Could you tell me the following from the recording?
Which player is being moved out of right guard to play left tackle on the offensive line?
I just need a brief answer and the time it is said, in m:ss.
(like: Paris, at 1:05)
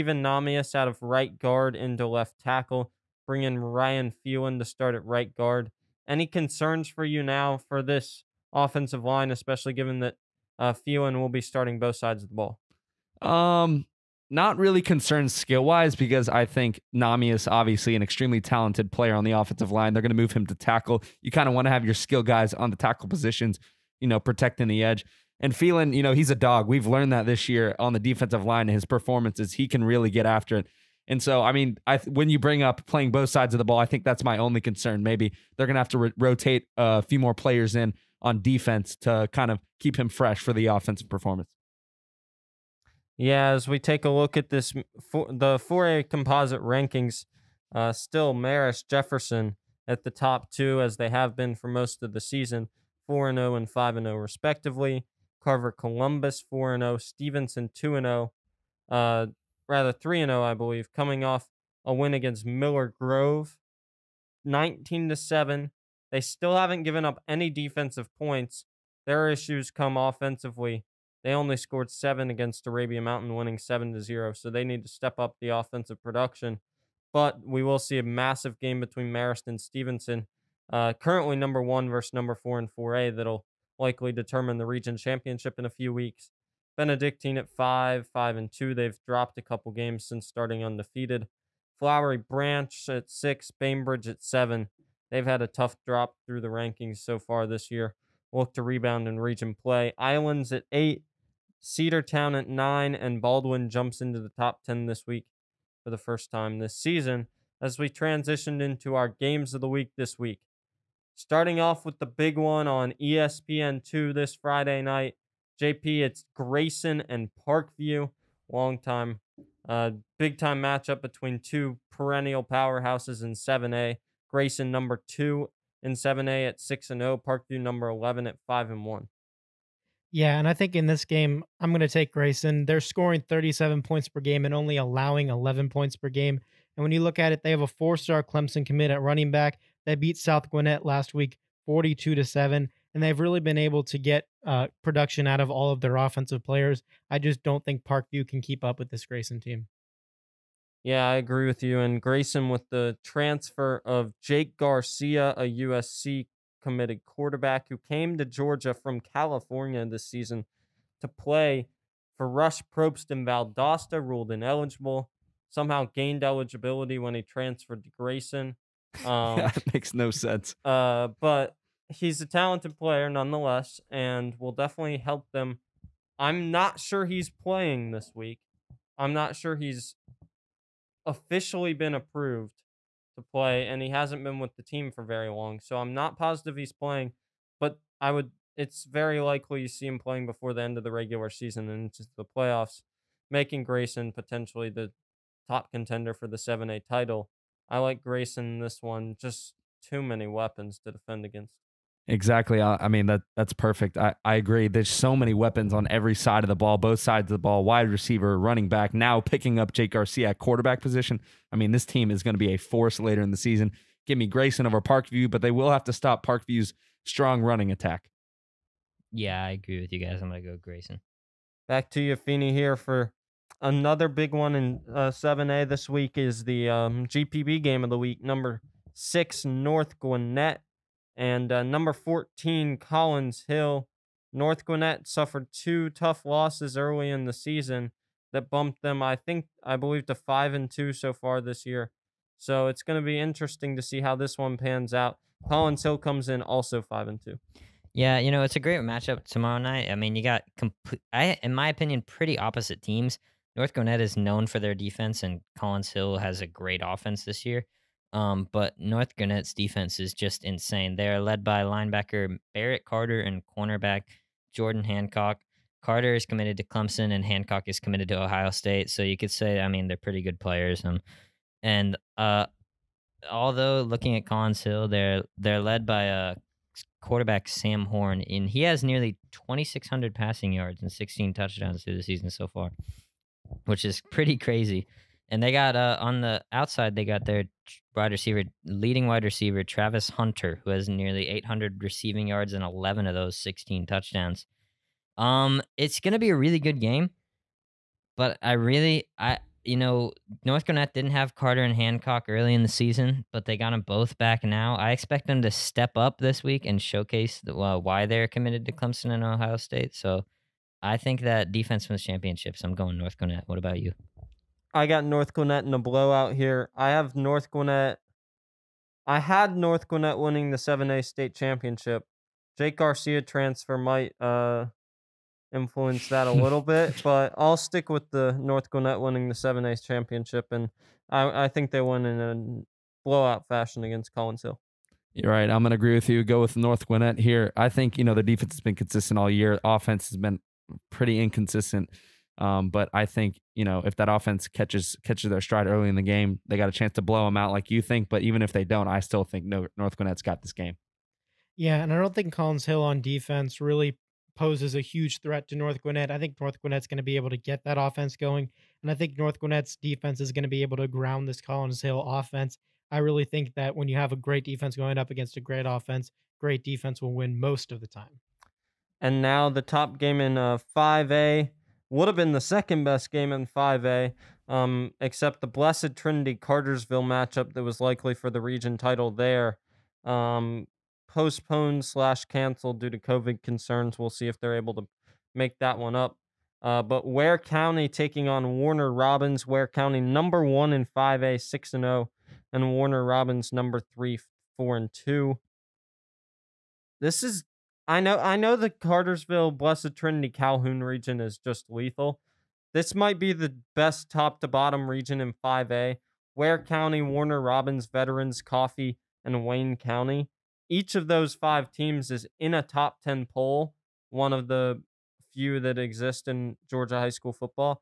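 Namias, at 0:00.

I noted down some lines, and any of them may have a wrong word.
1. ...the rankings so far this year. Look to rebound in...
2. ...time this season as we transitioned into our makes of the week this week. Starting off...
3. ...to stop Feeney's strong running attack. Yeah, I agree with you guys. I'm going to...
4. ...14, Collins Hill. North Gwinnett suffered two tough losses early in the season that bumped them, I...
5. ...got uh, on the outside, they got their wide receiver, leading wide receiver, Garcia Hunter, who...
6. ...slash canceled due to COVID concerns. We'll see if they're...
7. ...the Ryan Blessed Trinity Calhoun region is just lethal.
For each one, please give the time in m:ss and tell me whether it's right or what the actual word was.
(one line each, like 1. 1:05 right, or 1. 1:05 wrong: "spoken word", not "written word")
1. 1:36 right
2. 1:46 wrong: "games", not "makes"
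3. 3:35 wrong: "Parkview", not "Feeney"
4. 3:51 right
5. 4:45 wrong: "Travis", not "Garcia"
6. 6:21 right
7. 6:38 wrong: "Cartersville", not "Ryan".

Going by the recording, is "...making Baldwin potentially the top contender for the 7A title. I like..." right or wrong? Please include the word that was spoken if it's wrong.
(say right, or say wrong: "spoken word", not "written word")
wrong: "Grayson", not "Baldwin".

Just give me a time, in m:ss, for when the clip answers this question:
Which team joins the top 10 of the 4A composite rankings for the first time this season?
1:43.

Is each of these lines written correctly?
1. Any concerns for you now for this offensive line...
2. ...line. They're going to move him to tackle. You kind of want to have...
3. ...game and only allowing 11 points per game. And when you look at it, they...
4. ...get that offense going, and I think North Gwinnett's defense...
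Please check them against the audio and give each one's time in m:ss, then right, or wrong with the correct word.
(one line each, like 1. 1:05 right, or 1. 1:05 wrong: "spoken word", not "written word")
1. 0:06 right
2. 0:19 right
3. 2:14 right
4. 5:57 right.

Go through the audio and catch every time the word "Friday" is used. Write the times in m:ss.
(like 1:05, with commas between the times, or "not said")
1:54.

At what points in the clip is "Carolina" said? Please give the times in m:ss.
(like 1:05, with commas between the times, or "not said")
5:00, 5:13.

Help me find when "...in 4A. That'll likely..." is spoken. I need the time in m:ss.
1:22.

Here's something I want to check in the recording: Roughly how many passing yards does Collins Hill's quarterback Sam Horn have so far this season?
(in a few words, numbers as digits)
2,600.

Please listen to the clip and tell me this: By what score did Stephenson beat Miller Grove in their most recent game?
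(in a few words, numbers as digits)
19 to 7.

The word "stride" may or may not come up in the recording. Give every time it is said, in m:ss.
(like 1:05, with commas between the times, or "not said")
5:45.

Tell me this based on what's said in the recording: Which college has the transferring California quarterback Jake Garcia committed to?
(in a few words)
USC.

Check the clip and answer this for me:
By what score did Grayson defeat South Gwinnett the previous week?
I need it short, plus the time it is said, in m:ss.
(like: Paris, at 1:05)
42 to 7, at 2:21.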